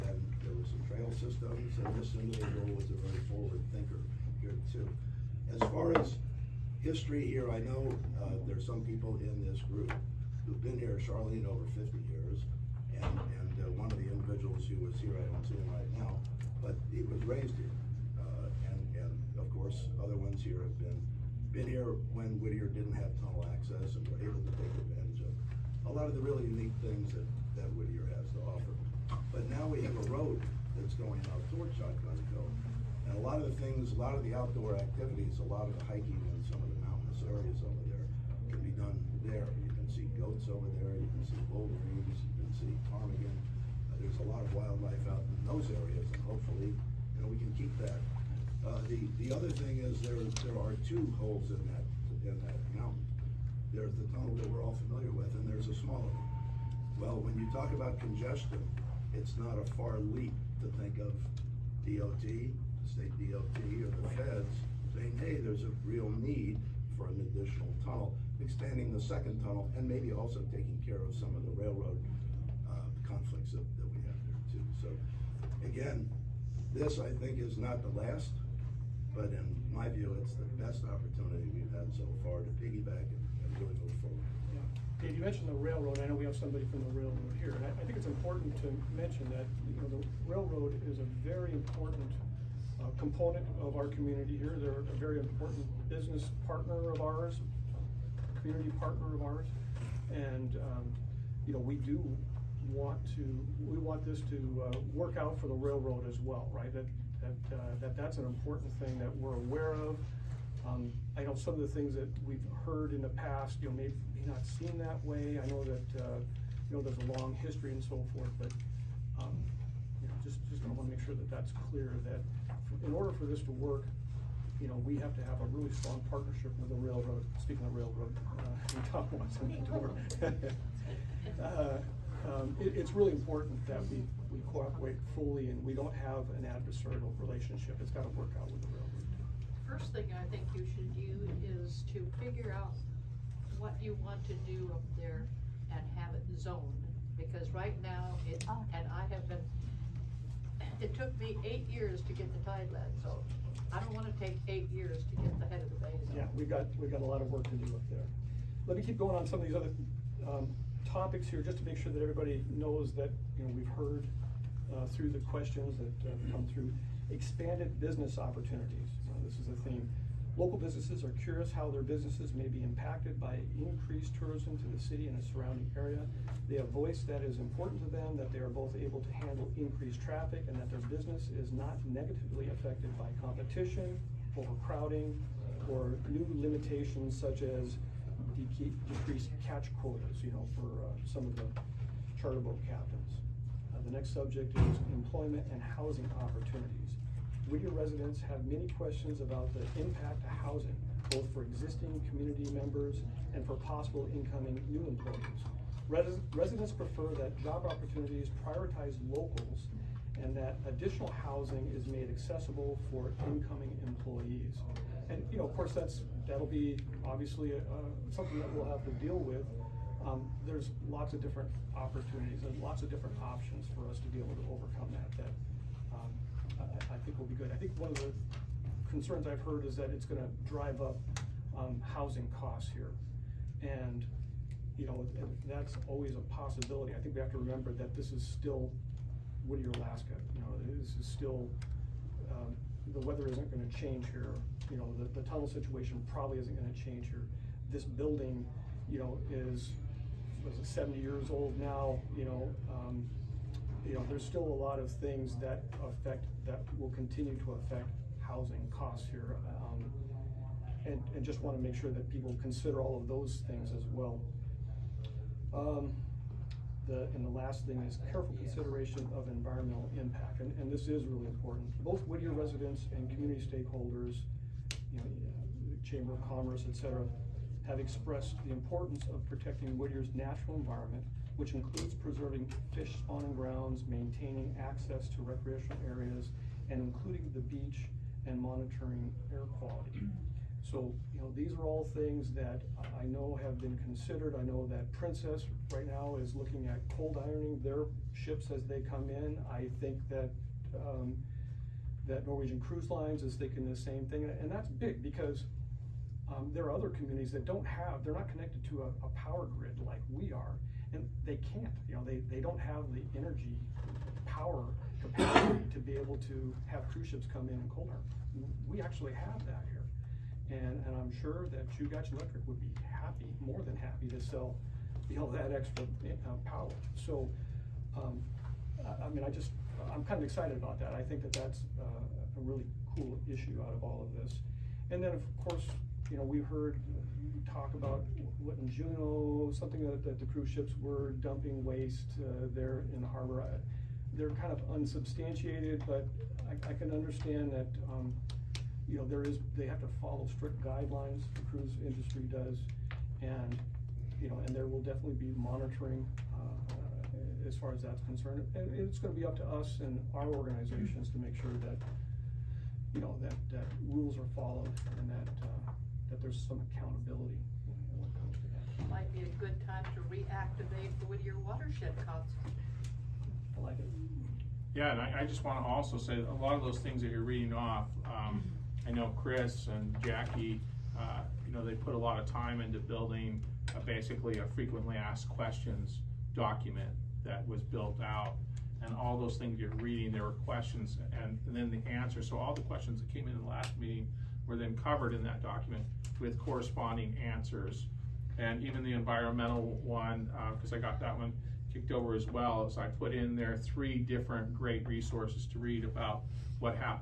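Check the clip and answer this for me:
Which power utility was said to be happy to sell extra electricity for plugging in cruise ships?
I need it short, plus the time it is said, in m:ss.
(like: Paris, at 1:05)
Chugach Electric, at 5:21.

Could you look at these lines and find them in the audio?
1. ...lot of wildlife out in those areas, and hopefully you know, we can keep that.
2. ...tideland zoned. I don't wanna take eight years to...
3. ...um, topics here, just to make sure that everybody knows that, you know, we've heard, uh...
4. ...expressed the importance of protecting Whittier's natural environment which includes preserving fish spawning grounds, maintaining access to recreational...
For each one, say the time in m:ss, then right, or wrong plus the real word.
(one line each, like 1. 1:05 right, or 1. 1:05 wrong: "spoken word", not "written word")
1. 0:44 right
2. 2:32 right
3. 2:40 right
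4. 4:37 right.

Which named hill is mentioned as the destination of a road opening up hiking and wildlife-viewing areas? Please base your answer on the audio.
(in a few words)
Shotgun Hill.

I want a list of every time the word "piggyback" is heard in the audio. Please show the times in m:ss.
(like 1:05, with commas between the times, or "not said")
1:22.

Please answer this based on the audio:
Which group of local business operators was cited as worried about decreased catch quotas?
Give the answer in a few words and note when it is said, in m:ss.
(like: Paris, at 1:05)
charter boat captains, at 3:12.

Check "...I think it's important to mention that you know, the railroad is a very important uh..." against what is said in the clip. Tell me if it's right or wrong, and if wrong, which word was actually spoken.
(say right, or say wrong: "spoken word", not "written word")
right.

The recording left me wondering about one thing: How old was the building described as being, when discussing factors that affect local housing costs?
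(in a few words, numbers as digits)
70 years.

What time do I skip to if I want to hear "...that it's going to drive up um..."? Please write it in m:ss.
3:49.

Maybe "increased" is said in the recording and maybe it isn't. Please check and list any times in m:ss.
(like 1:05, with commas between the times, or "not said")
2:53, 2:59.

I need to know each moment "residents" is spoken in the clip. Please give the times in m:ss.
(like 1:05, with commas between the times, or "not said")
3:17, 3:26, 4:32.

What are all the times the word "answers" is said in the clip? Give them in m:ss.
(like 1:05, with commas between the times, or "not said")
6:31, 6:37.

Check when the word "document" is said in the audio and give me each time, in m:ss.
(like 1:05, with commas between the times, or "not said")
6:26, 6:35.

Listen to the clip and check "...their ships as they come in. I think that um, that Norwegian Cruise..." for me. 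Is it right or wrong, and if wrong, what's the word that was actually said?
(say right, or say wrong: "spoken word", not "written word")
right.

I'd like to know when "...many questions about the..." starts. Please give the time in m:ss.
3:18.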